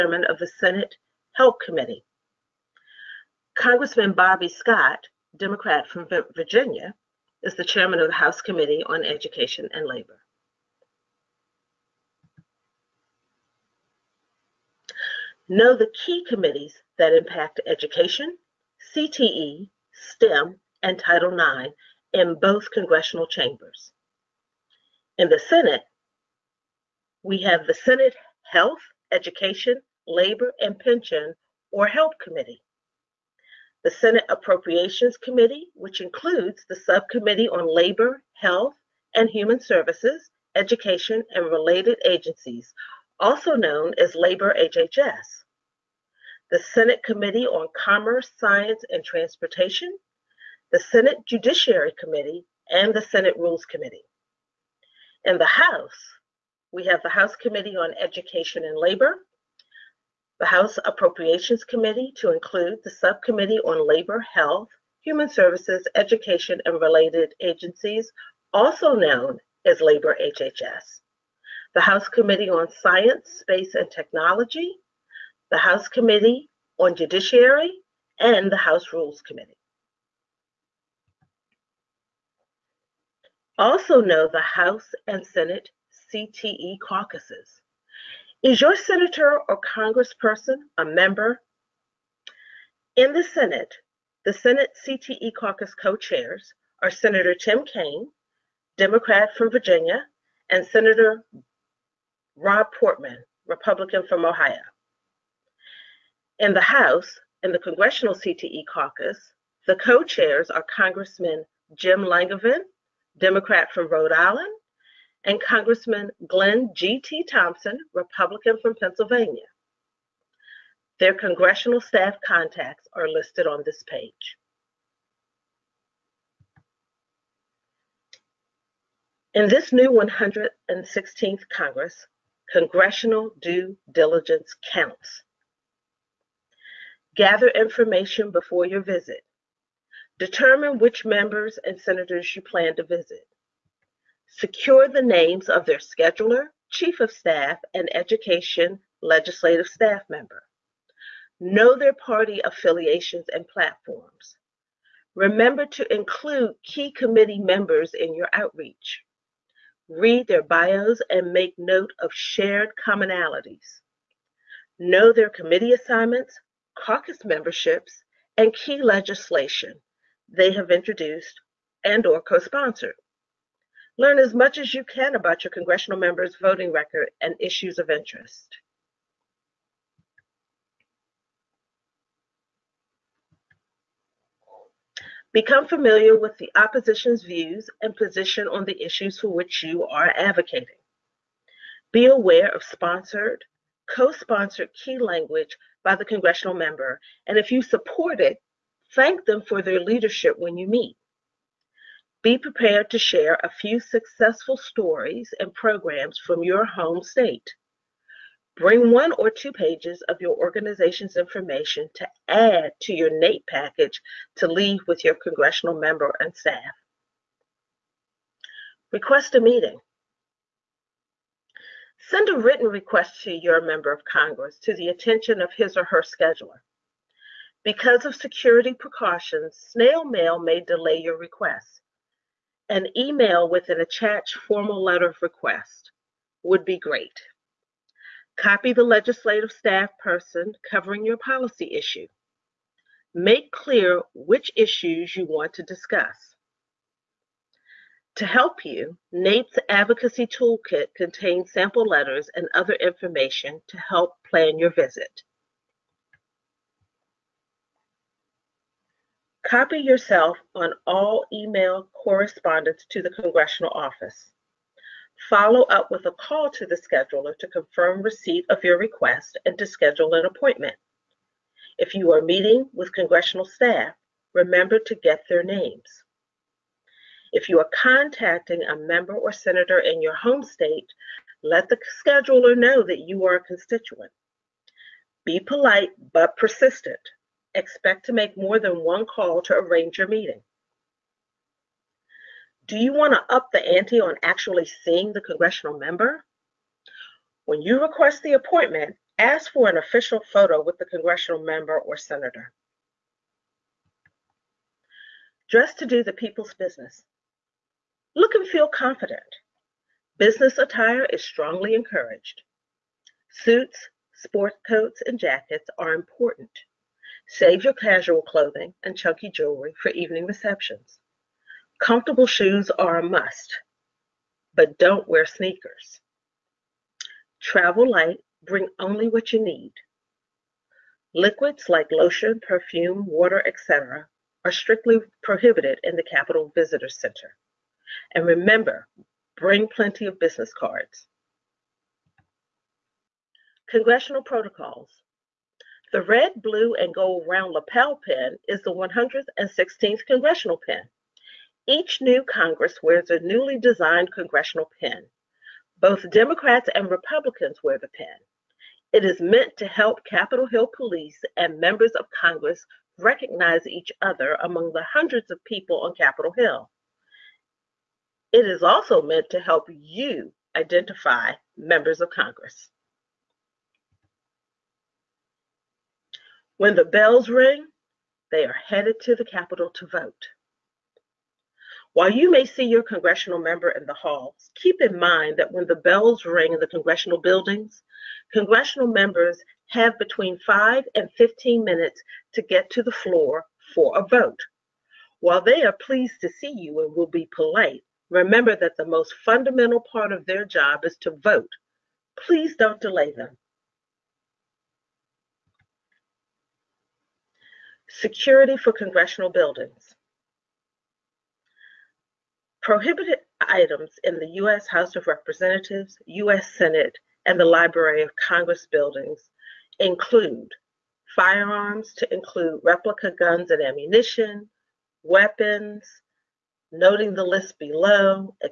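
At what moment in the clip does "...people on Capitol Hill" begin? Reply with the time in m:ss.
6:05.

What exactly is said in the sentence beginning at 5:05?
Dress to do the people's business.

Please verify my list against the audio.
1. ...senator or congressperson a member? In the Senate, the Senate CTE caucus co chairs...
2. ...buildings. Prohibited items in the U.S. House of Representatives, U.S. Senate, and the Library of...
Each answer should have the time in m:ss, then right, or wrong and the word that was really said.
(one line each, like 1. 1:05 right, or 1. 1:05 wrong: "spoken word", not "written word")
1. 1:28 right
2. 6:49 right.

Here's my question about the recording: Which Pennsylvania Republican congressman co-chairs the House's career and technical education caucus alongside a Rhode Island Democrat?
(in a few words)
Glenn G.T. Thompson.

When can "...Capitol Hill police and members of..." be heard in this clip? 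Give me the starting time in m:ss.
6:00.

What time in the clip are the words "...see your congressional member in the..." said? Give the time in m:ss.
6:22.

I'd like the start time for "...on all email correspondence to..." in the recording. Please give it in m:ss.
4:20.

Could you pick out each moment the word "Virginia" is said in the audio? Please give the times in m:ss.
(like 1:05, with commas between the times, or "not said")
0:06, 1:39.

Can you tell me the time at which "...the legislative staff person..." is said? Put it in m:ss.
3:58.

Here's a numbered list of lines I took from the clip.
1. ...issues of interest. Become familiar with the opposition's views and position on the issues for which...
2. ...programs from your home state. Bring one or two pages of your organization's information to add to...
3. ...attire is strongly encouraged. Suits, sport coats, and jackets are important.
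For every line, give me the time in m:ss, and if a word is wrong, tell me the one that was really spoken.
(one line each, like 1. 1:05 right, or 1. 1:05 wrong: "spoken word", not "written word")
1. 2:57 right
2. 3:25 right
3. 5:10 right.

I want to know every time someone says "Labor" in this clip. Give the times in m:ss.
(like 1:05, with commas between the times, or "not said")
0:09, 0:30, 0:37, 0:44, 0:58, 1:03, 1:09.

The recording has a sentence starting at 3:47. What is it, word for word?
Because of security precautions, snail mail may delay your request.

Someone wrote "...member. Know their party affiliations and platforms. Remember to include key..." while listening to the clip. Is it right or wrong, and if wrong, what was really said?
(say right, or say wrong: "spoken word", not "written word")
right.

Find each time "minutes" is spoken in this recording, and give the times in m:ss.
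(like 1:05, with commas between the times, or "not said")
6:31.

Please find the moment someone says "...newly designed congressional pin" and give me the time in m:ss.
5:53.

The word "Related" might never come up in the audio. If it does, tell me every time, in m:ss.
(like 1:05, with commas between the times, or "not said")
0:41, 1:06.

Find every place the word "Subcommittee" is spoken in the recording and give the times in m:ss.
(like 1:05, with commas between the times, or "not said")
0:36, 1:02.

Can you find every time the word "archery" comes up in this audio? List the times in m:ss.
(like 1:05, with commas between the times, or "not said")
not said.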